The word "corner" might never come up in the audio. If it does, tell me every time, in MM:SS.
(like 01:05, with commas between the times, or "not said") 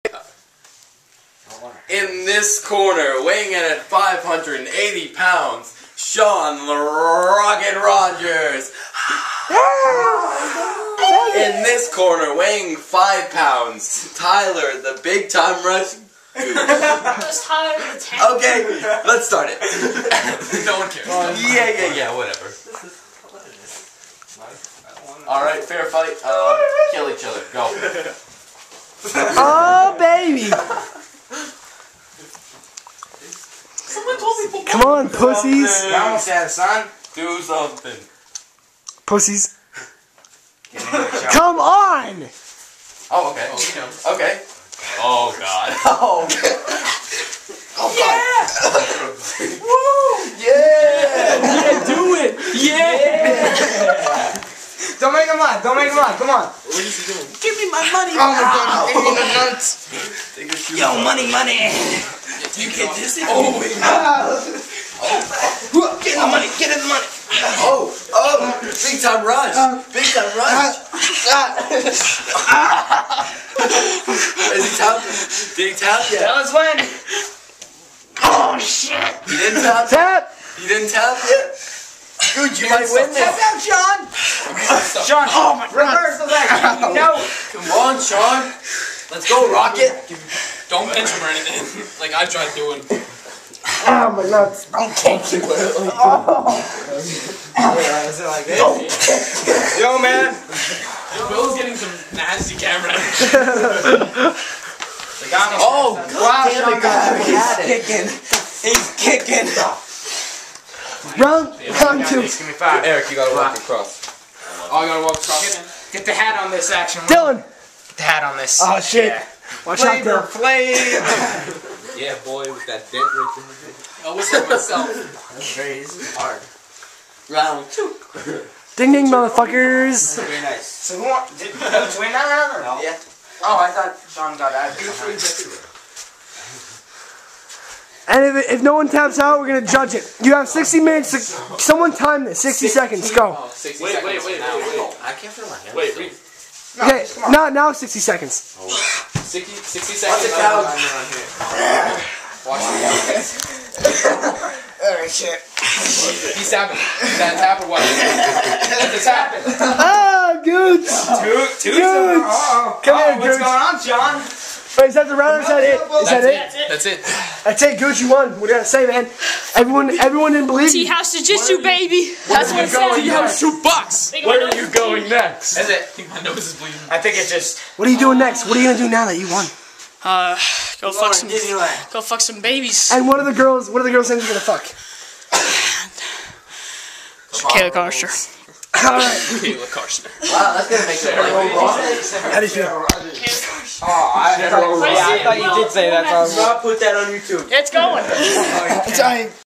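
00:02, 00:11.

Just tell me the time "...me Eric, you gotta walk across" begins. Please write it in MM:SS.
01:52.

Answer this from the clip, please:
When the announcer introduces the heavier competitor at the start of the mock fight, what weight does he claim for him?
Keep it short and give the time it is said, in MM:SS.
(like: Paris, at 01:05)
580 pounds, at 00:03.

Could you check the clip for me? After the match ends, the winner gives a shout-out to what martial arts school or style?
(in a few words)
Tea House Jiu Jitsu.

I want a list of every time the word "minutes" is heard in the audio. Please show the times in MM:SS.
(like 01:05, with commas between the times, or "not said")
02:20.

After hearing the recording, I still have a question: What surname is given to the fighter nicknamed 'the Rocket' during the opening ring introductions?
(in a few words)
Rogers.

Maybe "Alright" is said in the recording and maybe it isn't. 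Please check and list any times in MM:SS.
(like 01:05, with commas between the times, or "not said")
00:25, 02:34, 03:08.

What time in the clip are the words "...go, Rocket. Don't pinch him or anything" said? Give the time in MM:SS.
01:29.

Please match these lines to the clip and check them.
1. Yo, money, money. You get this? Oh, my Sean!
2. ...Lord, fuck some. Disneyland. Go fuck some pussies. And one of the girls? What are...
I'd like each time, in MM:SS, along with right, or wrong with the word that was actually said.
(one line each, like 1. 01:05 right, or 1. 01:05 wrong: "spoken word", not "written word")
1. 01:00 wrong: "God", not "Sean"
2. 03:00 wrong: "babies", not "pussies".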